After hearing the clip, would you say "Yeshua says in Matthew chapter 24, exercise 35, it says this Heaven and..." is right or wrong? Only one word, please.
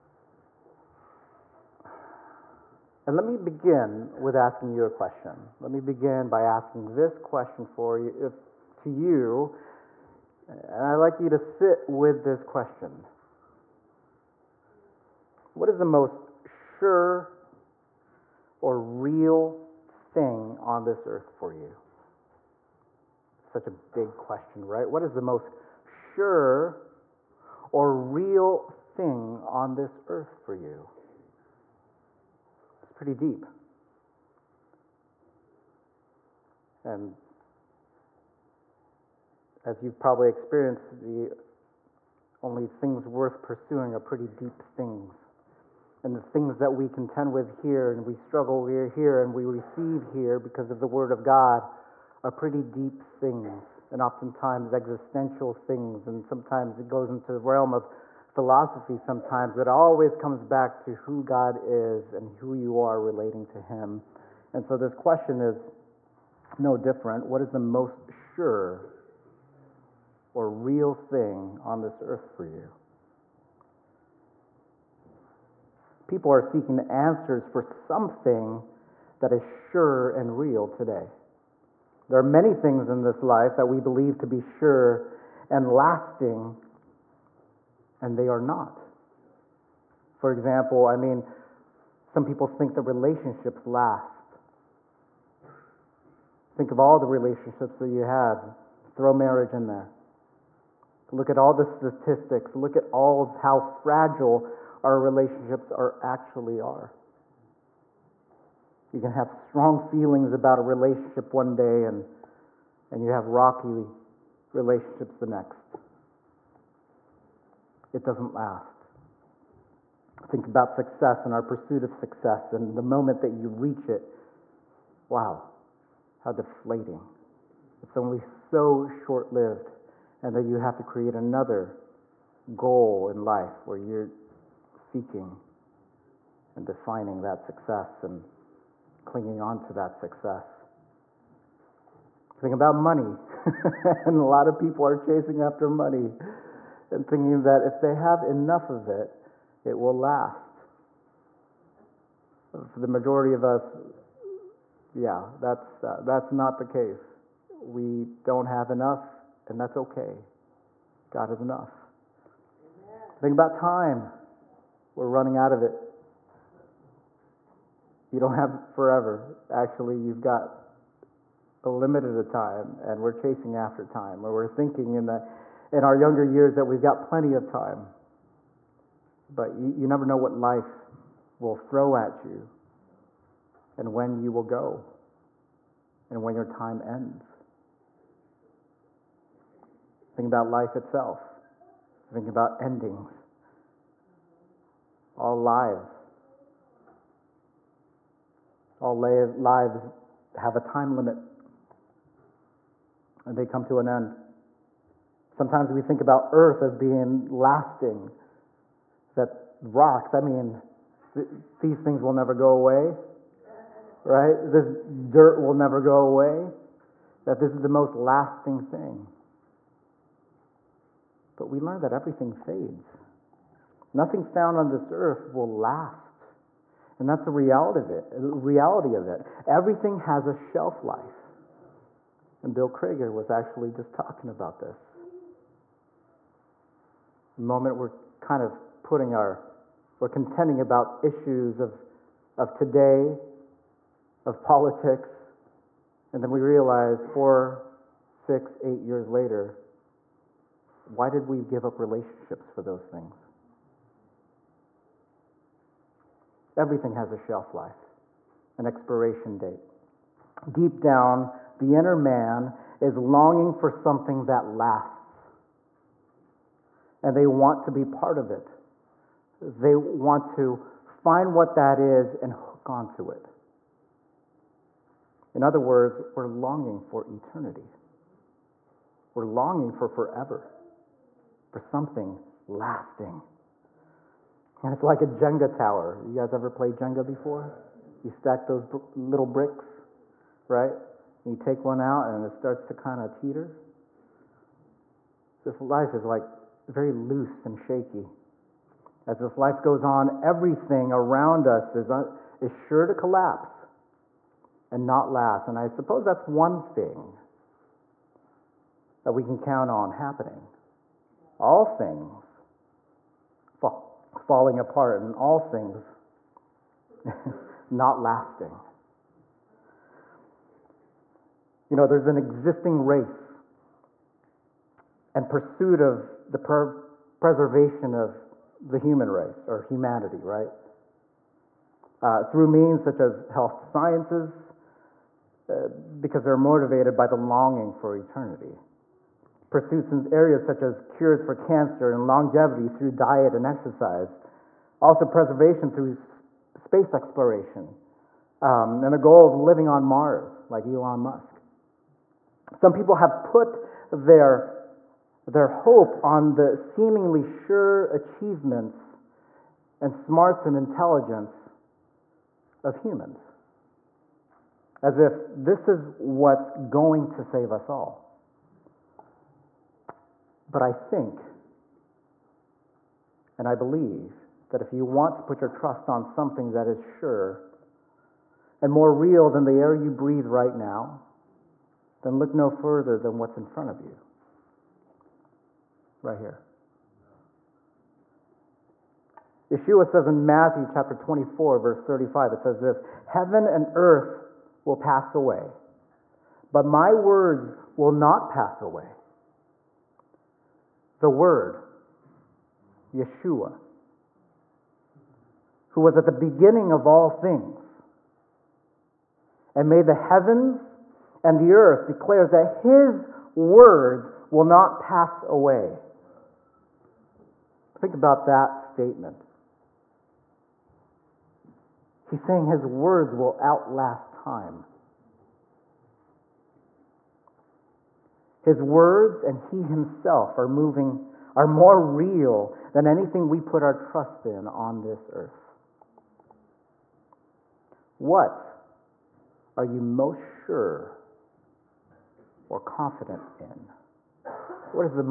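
wrong.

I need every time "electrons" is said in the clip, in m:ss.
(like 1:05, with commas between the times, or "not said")
not said.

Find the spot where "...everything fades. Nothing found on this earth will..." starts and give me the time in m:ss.
3:41.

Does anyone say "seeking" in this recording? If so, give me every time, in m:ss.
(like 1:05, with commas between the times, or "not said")
1:16, 2:14.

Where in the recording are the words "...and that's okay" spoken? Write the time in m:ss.
2:39.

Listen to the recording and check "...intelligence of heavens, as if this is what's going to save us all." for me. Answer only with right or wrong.
wrong.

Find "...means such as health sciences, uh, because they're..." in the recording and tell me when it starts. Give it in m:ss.
5:32.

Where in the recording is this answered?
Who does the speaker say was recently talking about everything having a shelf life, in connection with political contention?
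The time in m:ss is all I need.
3:52.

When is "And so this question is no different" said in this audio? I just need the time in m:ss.
1:04.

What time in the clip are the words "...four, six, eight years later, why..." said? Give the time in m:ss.
4:07.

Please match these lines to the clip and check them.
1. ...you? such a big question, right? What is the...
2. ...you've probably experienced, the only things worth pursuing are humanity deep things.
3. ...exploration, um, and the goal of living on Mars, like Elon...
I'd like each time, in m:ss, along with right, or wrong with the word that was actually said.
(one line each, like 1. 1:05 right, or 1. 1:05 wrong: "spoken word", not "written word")
1. 0:21 right
2. 0:39 wrong: "pretty", not "humanity"
3. 5:46 right.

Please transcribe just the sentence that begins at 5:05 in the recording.
And I suppose that's one thing that we can count on happening.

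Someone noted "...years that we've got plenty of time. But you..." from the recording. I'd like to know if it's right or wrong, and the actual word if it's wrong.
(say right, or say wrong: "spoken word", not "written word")
right.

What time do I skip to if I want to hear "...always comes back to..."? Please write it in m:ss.
0:59.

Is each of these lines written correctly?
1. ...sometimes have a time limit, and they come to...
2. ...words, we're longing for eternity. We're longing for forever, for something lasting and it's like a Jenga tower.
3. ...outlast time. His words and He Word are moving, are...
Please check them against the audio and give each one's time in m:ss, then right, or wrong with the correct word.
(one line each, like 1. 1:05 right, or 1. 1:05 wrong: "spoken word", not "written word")
1. 3:18 wrong: "lives", not "sometimes"
2. 4:35 right
3. 7:03 wrong: "Himself", not "Word".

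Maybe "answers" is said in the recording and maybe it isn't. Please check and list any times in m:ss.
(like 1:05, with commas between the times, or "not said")
1:16.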